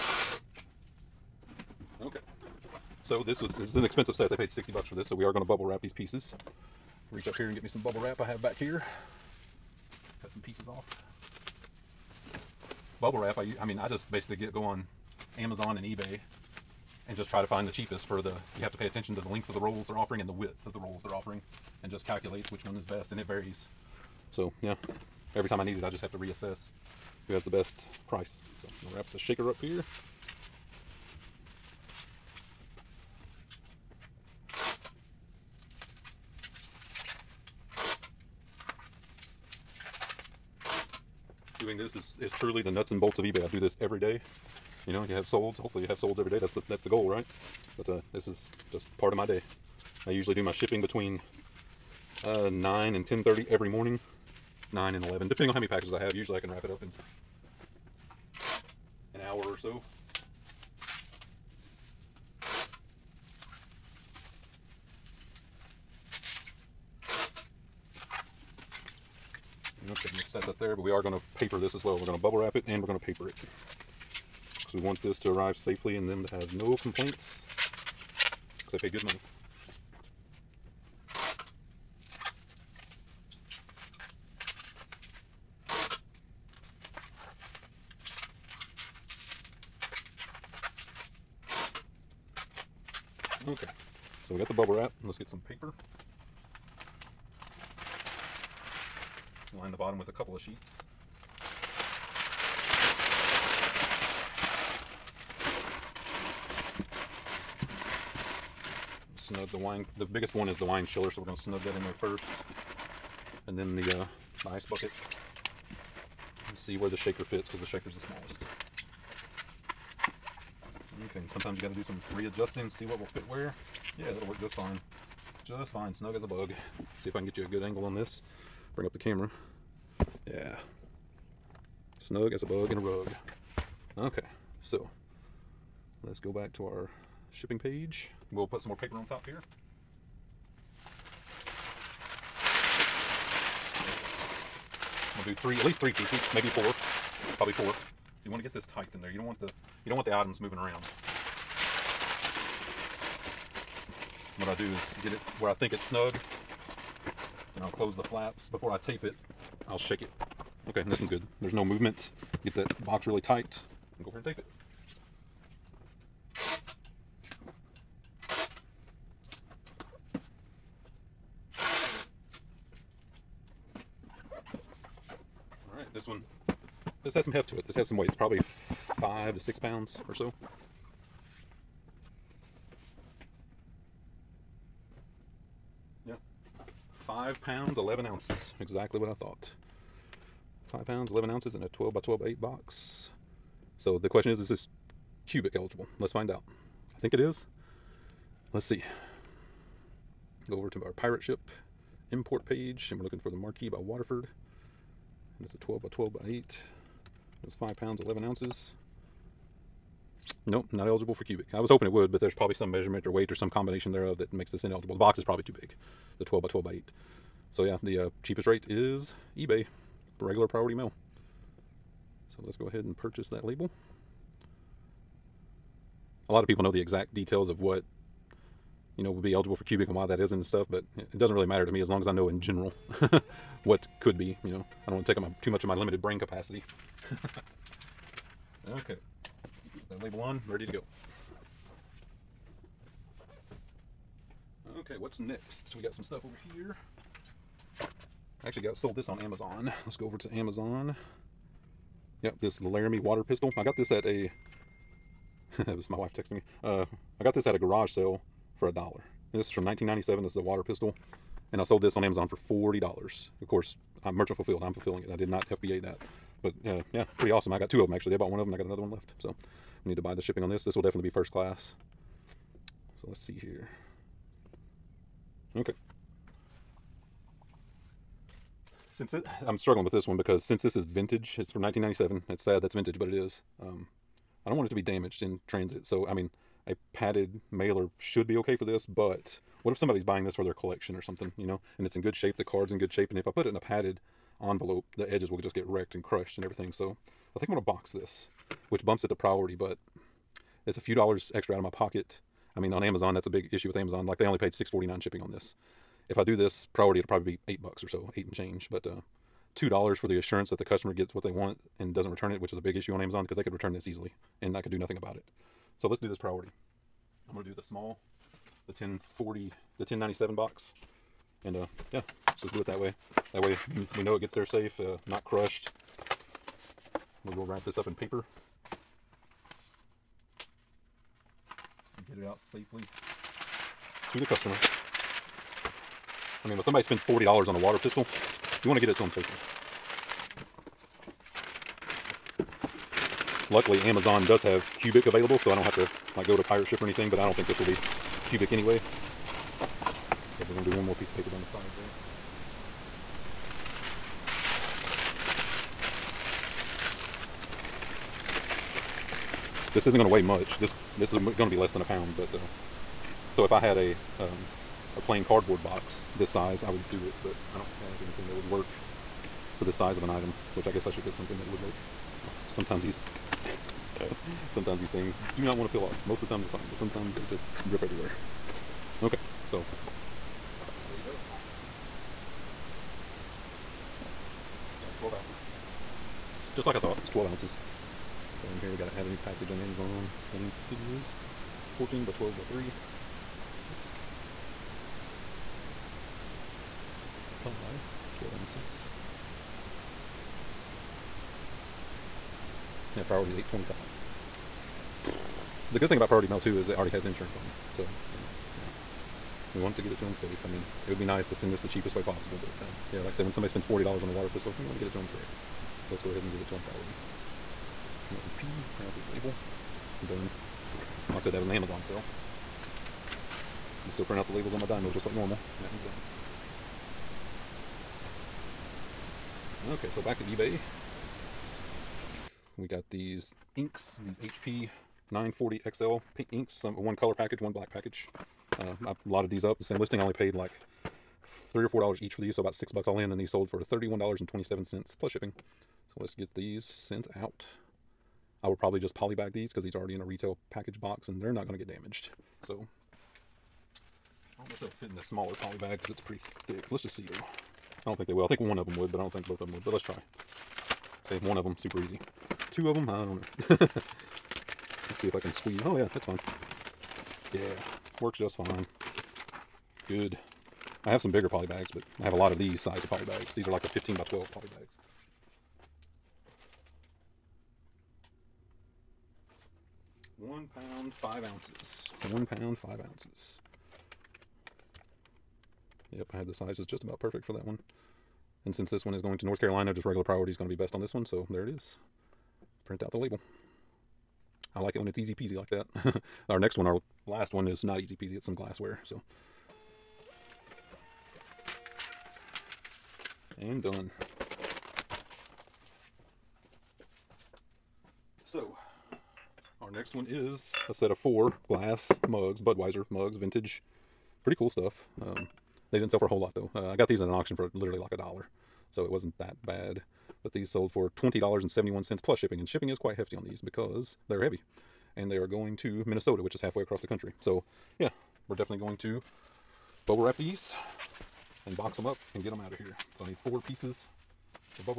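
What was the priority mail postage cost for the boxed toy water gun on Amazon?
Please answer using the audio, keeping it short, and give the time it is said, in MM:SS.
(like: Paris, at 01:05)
$8.25, at 06:43.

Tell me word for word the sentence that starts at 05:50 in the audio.
Okay, we're going to do one more piece of paper down the side there.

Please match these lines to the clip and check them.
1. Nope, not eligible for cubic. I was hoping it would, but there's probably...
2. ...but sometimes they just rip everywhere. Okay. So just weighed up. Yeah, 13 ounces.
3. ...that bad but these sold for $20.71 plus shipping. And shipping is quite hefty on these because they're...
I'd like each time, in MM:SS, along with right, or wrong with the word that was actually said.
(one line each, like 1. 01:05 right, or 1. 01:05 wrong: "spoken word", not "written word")
1. 03:30 right
2. 06:16 wrong: "12", not "13"
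3. 08:39 right.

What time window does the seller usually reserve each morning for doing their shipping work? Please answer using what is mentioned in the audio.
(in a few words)
9 to 10:30.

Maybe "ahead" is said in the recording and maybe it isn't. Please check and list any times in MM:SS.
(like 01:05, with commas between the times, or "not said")
03:42, 06:56.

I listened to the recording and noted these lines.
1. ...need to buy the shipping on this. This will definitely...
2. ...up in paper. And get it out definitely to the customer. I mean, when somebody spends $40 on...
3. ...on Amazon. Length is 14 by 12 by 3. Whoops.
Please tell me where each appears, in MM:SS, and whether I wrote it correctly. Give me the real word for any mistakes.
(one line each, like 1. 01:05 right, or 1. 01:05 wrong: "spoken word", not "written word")
1. 04:29 right
2. 05:27 wrong: "safely", not "definitely"
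3. 06:29 right.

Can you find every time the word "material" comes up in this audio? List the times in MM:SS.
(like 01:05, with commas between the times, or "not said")
not said.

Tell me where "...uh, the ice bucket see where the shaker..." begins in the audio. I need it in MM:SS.
01:54.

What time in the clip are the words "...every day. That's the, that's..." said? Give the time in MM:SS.
00:46.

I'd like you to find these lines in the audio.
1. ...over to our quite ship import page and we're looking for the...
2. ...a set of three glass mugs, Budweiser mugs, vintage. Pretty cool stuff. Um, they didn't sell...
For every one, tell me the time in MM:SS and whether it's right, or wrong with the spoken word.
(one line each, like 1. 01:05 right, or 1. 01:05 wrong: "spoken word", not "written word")
1. 03:20 wrong: "pirate", not "quite"
2. 08:30 wrong: "four", not "three".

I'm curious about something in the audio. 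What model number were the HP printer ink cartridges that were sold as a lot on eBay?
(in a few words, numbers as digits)
940 XL.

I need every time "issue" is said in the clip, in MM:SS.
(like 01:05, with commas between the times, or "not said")
05:03, 05:12.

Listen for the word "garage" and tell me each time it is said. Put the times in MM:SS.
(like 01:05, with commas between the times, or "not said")
04:17.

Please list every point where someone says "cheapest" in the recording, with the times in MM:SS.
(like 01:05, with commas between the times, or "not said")
00:17, 03:38, 06:51.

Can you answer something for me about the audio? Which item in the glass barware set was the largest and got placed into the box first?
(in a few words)
The wine chiller.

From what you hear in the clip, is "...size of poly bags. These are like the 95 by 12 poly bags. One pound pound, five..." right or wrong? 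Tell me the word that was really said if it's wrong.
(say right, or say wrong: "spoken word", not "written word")
wrong: "15", not "95".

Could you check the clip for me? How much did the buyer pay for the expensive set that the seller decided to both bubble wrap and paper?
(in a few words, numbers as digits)
$60.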